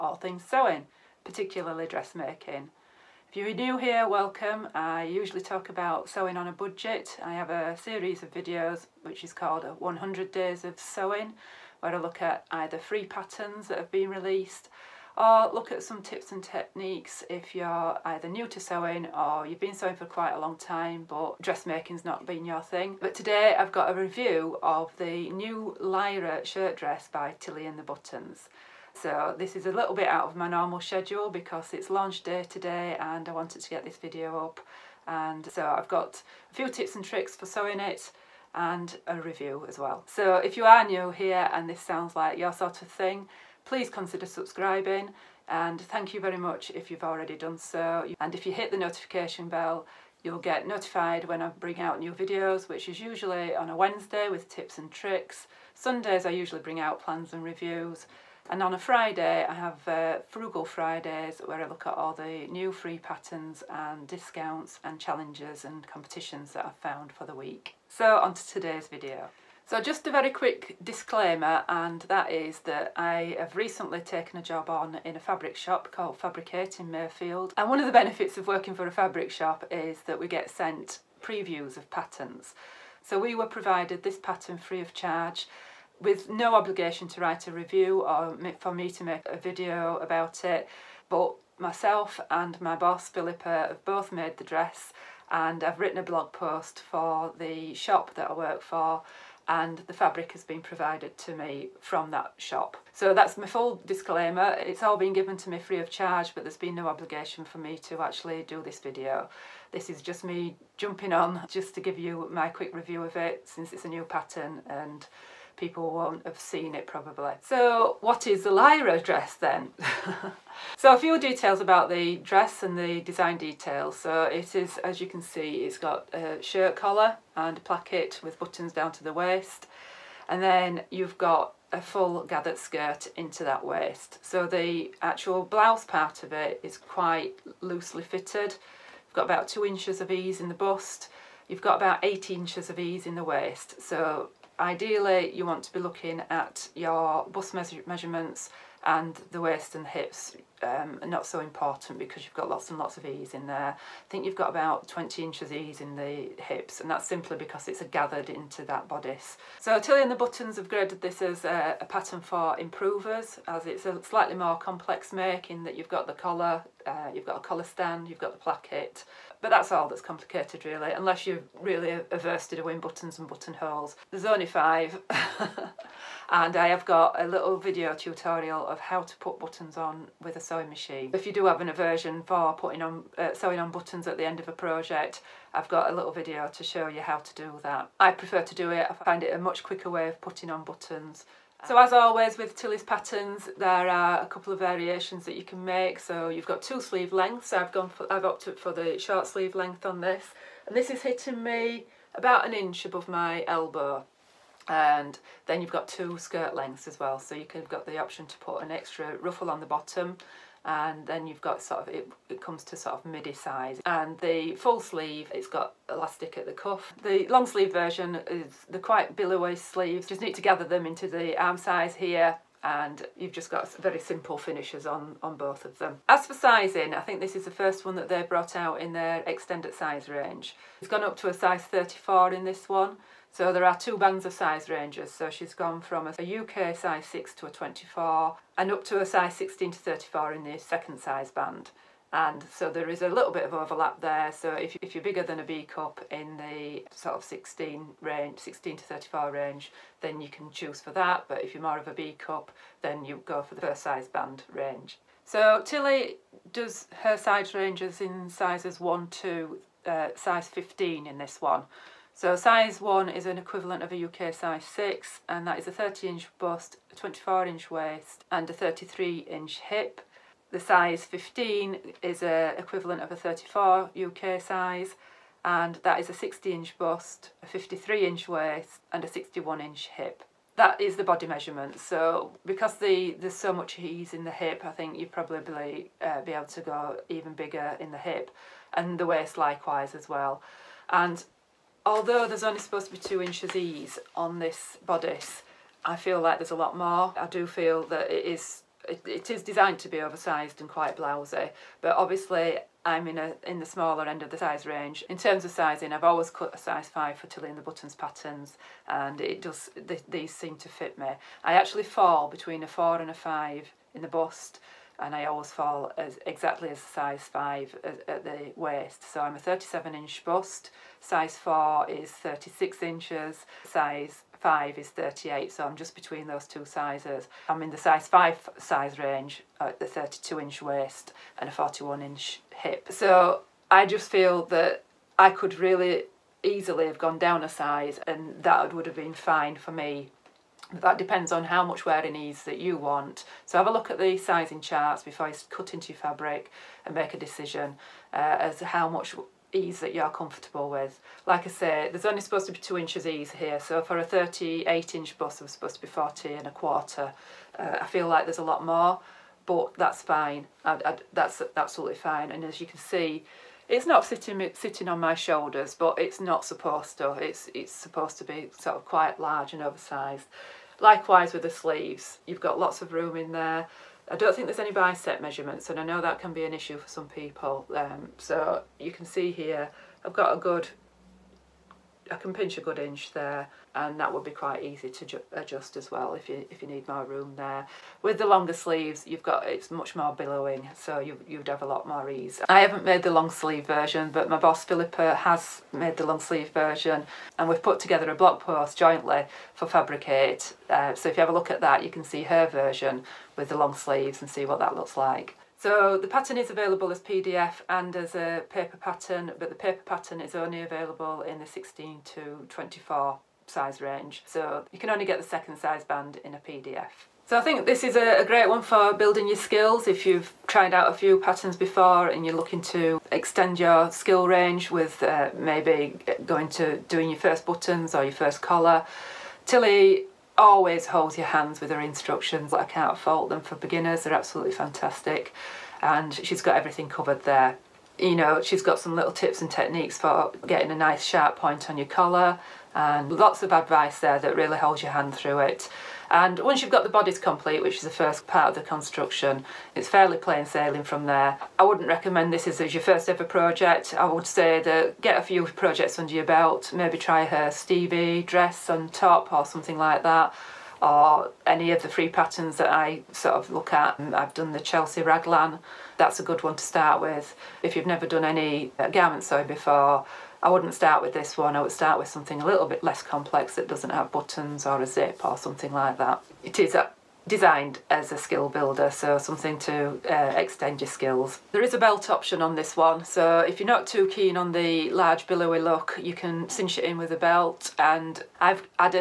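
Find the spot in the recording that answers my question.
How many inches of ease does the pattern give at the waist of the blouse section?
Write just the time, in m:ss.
2:22.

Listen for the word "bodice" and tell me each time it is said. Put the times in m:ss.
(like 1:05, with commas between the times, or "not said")
2:38, 4:54, 7:26.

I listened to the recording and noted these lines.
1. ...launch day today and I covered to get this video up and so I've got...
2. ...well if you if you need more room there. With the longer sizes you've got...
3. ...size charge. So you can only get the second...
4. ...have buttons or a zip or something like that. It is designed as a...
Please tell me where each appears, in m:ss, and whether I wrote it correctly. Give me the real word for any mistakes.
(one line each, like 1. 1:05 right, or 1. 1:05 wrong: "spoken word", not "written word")
1. 0:31 wrong: "wanted", not "covered"
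2. 6:25 wrong: "sleeves", not "sizes"
3. 6:53 wrong: "range", not "charge"
4. 7:53 right.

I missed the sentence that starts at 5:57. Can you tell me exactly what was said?
Uh, I feel like there's a lot more, but that's fine.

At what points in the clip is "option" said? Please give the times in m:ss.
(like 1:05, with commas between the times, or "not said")
3:27, 8:02.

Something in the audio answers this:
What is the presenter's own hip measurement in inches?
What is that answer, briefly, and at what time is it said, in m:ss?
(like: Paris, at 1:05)
41 inches, at 5:31.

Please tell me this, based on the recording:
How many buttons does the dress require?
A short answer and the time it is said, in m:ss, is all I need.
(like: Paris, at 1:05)
5, at 2:54.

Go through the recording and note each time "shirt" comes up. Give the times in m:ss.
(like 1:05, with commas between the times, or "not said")
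0:26, 2:06.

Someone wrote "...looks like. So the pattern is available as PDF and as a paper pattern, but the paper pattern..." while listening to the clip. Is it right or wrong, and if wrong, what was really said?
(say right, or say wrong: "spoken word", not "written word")
right.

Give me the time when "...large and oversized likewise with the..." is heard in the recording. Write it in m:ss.
6:09.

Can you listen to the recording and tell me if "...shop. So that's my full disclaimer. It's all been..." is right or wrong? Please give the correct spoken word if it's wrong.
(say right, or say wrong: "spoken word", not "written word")
right.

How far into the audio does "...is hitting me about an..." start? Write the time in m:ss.
3:20.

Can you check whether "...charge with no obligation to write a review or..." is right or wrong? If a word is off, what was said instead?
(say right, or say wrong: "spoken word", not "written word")
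right.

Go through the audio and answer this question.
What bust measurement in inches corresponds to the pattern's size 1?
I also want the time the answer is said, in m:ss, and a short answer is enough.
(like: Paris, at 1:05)
30 inches, at 4:25.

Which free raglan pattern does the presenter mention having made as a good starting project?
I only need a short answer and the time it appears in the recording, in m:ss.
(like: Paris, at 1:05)
Chelsea raglan, at 7:44.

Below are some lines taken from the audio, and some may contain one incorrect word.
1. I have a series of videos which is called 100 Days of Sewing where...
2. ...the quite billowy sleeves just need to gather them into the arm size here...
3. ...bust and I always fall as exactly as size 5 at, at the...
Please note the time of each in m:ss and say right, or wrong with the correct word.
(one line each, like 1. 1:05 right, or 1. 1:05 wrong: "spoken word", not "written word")
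1. 0:07 right
2. 3:38 right
3. 5:14 right.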